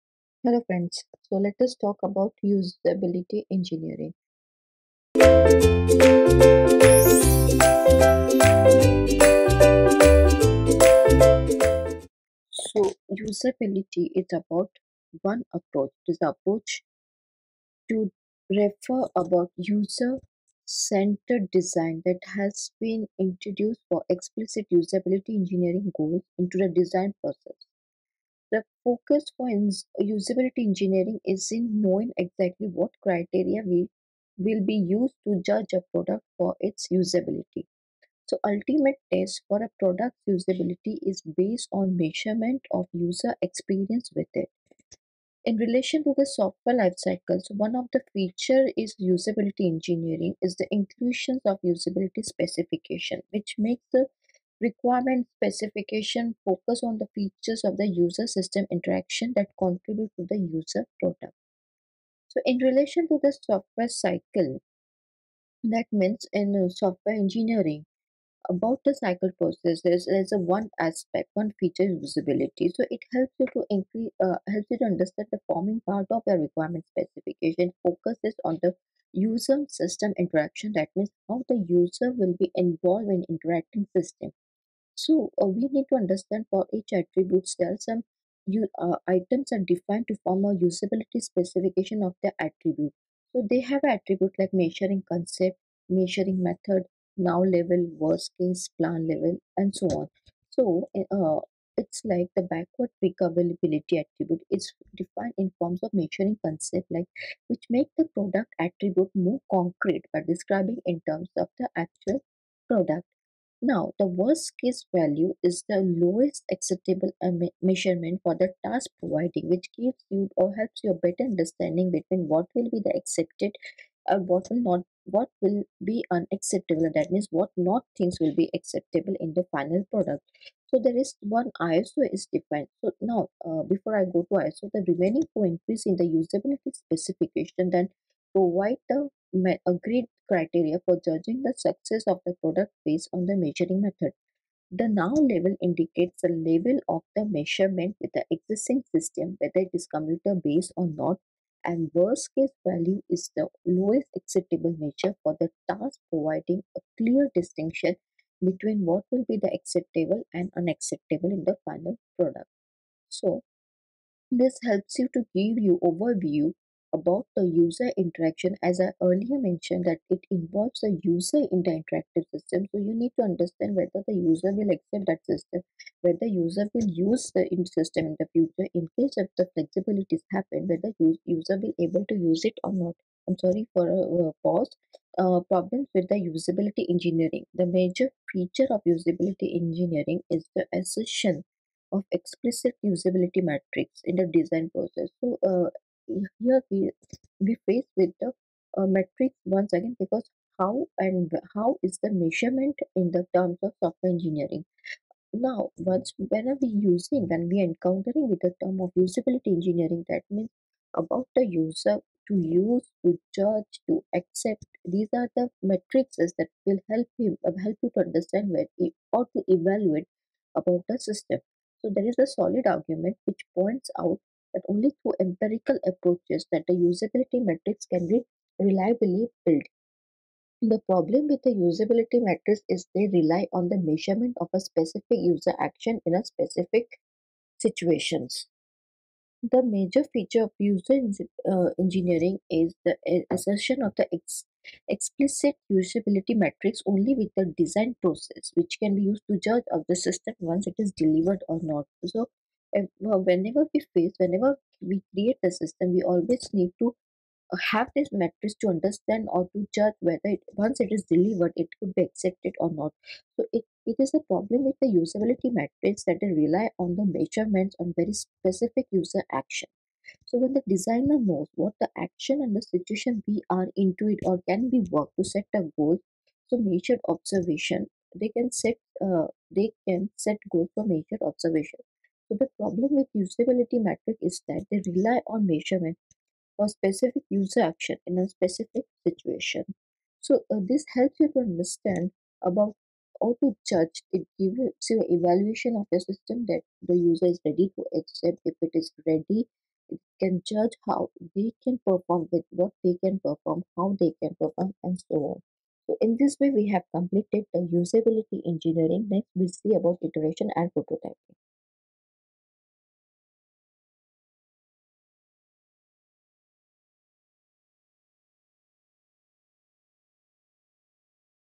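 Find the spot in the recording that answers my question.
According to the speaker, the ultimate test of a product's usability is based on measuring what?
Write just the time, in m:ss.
0:42.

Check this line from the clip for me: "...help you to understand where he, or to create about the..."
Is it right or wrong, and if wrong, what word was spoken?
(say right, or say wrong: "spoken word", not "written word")
wrong: "evaluate", not "create".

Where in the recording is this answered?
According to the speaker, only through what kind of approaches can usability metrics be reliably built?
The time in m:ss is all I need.
3:45.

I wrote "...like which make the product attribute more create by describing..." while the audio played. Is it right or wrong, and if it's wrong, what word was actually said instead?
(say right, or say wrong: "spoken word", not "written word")
wrong: "concrete", not "create".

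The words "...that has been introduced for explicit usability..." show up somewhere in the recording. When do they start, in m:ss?
0:22.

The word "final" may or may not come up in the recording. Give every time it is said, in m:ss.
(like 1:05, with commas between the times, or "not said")
2:09, 2:41.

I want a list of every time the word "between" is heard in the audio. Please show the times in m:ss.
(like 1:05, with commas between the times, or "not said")
2:01, 2:38.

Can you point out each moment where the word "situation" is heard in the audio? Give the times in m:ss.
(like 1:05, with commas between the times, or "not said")
3:57, 4:32, 4:49.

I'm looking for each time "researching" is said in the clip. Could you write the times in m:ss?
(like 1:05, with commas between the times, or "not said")
not said.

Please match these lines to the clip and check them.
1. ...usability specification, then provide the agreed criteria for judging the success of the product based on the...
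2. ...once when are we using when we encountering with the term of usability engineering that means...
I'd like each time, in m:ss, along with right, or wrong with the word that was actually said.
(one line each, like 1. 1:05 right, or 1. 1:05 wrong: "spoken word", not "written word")
1. 2:16 right
2. 3:25 right.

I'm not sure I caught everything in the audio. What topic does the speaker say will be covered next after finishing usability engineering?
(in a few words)
iteration and prototyping.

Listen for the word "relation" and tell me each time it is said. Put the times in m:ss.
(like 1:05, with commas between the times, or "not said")
0:45, 1:02.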